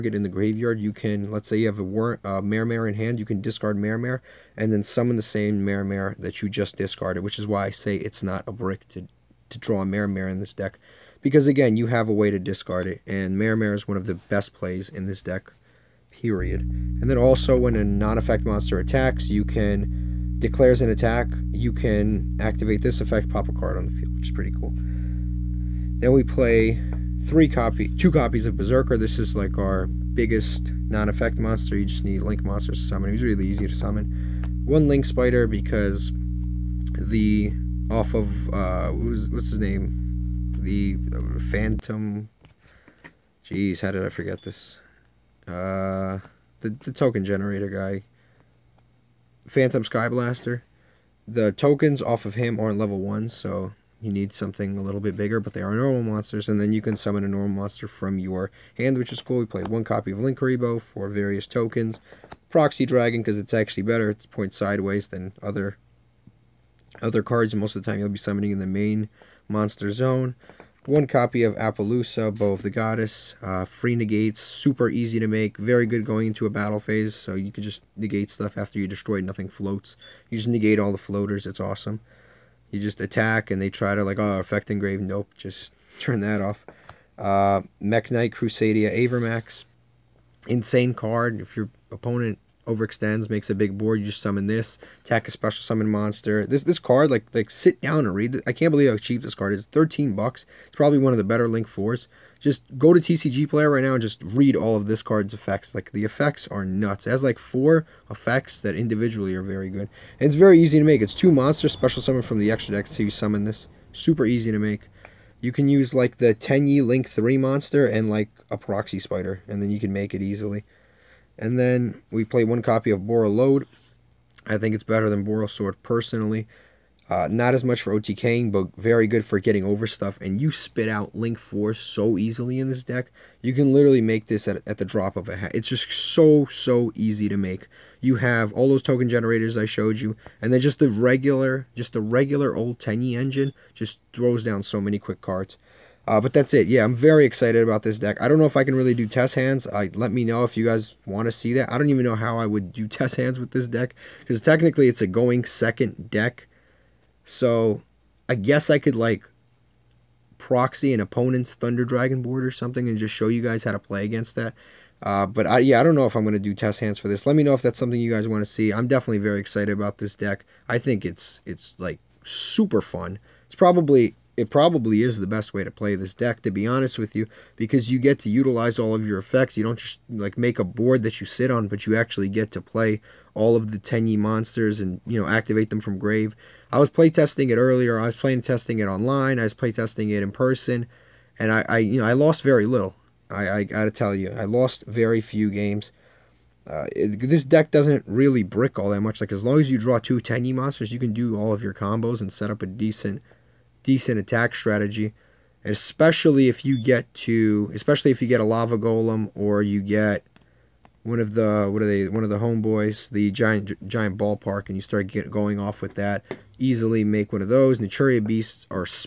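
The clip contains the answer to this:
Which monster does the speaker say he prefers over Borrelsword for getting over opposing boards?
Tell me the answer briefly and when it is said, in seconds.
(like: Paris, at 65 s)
Borreload, at 122 s.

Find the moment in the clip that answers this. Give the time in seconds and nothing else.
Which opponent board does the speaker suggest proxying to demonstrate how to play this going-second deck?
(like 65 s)
161 s.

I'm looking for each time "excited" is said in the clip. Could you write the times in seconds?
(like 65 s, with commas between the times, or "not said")
147 s, 169 s.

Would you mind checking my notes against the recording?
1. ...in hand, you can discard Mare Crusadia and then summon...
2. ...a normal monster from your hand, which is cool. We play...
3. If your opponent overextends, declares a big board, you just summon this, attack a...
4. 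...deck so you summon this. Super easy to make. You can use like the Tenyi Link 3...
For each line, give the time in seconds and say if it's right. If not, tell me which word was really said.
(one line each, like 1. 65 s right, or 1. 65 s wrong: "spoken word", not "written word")
1. 2 s wrong: "Mare", not "Crusadia"
2. 57 s right
3. 91 s wrong: "makes", not "declares"
4. 112 s right.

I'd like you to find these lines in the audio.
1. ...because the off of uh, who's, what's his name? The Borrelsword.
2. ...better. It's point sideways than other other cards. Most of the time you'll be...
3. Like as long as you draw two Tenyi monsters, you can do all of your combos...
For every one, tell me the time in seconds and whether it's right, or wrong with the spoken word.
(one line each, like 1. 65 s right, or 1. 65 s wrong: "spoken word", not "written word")
1. 35 s wrong: "Phantom", not "Borrelsword"
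2. 63 s right
3. 199 s right.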